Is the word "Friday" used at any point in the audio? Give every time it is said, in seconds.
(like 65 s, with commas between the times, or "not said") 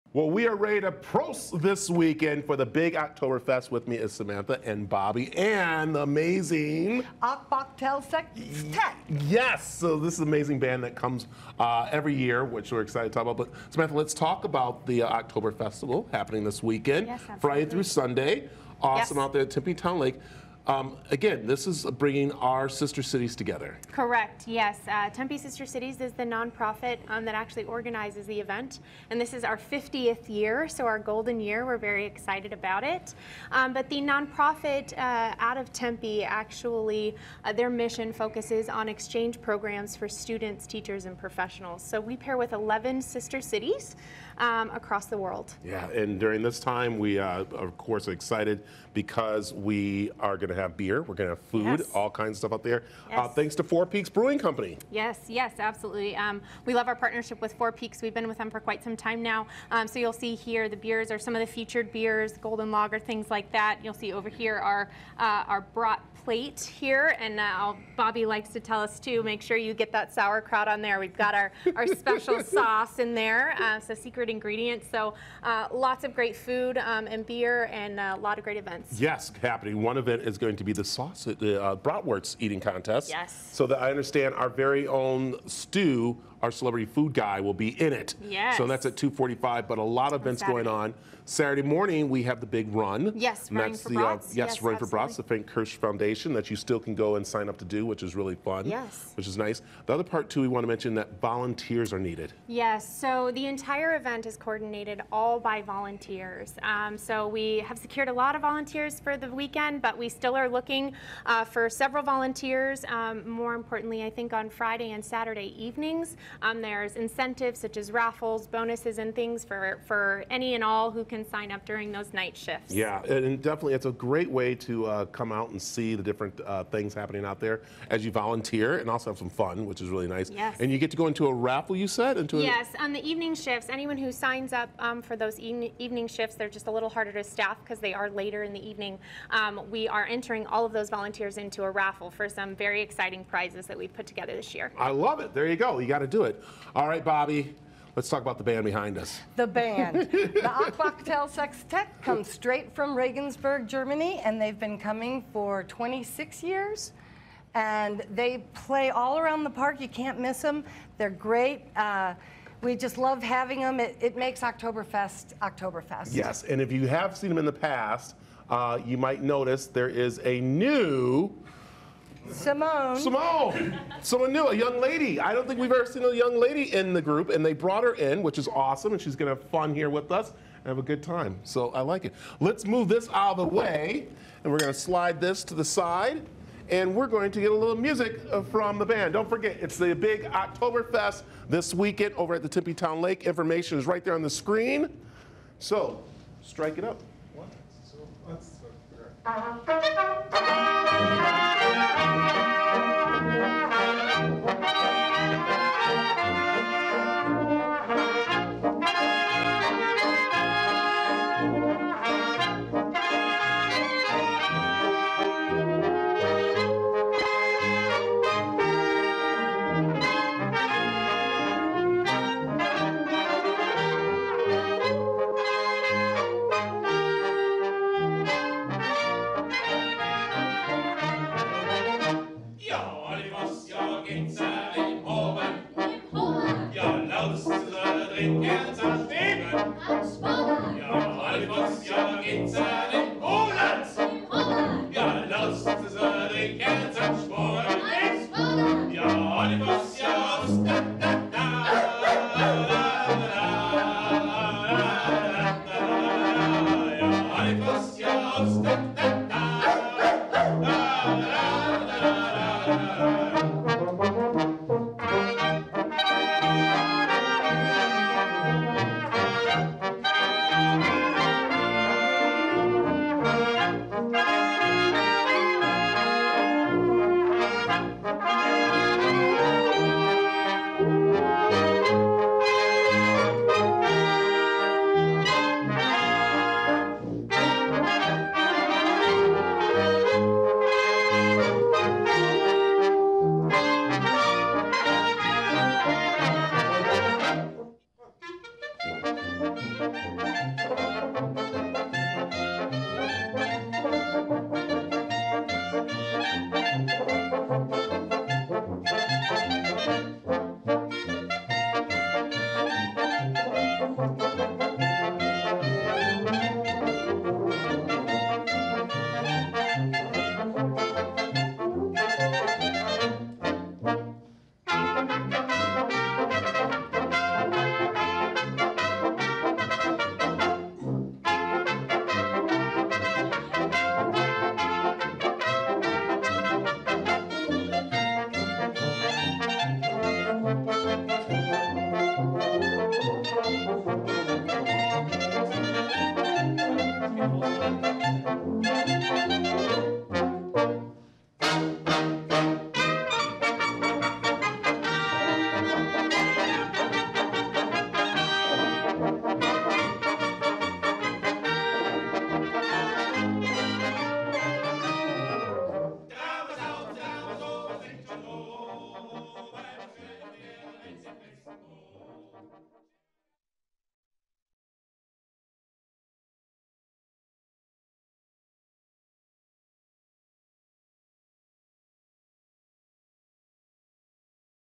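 17 s, 114 s.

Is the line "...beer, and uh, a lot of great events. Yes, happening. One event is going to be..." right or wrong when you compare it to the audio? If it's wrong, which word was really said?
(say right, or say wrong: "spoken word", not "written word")
right.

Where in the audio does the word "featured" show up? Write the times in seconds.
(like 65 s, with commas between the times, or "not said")
61 s.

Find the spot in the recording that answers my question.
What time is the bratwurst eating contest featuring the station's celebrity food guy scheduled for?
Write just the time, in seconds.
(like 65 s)
88 s.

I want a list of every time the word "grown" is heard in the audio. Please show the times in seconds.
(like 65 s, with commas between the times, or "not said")
not said.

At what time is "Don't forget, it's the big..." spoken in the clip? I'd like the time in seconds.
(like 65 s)
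189 s.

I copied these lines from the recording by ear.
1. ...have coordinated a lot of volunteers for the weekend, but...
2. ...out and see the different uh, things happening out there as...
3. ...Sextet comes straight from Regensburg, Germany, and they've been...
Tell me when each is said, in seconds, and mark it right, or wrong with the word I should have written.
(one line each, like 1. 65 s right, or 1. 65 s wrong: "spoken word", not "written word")
1. 107 s wrong: "secured", not "coordinated"
2. 125 s right
3. 151 s right.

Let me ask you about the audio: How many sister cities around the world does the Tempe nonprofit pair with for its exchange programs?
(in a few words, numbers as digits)
11.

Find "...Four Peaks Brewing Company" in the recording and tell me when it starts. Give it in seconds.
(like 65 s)
53 s.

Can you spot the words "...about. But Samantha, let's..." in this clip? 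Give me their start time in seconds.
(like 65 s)
13 s.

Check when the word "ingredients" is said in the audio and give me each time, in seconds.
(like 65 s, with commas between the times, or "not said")
74 s.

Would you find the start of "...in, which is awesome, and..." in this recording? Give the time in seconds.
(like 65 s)
177 s.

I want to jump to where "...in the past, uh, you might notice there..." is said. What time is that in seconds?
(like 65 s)
167 s.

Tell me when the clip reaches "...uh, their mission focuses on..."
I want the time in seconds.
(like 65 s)
37 s.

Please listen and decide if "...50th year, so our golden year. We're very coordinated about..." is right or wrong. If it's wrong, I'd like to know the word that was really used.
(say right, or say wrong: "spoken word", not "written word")
wrong: "excited", not "coordinated".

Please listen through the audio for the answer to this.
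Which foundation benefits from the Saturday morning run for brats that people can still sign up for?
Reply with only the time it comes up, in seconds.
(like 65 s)
95 s.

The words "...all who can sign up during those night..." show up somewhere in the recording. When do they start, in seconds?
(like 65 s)
120 s.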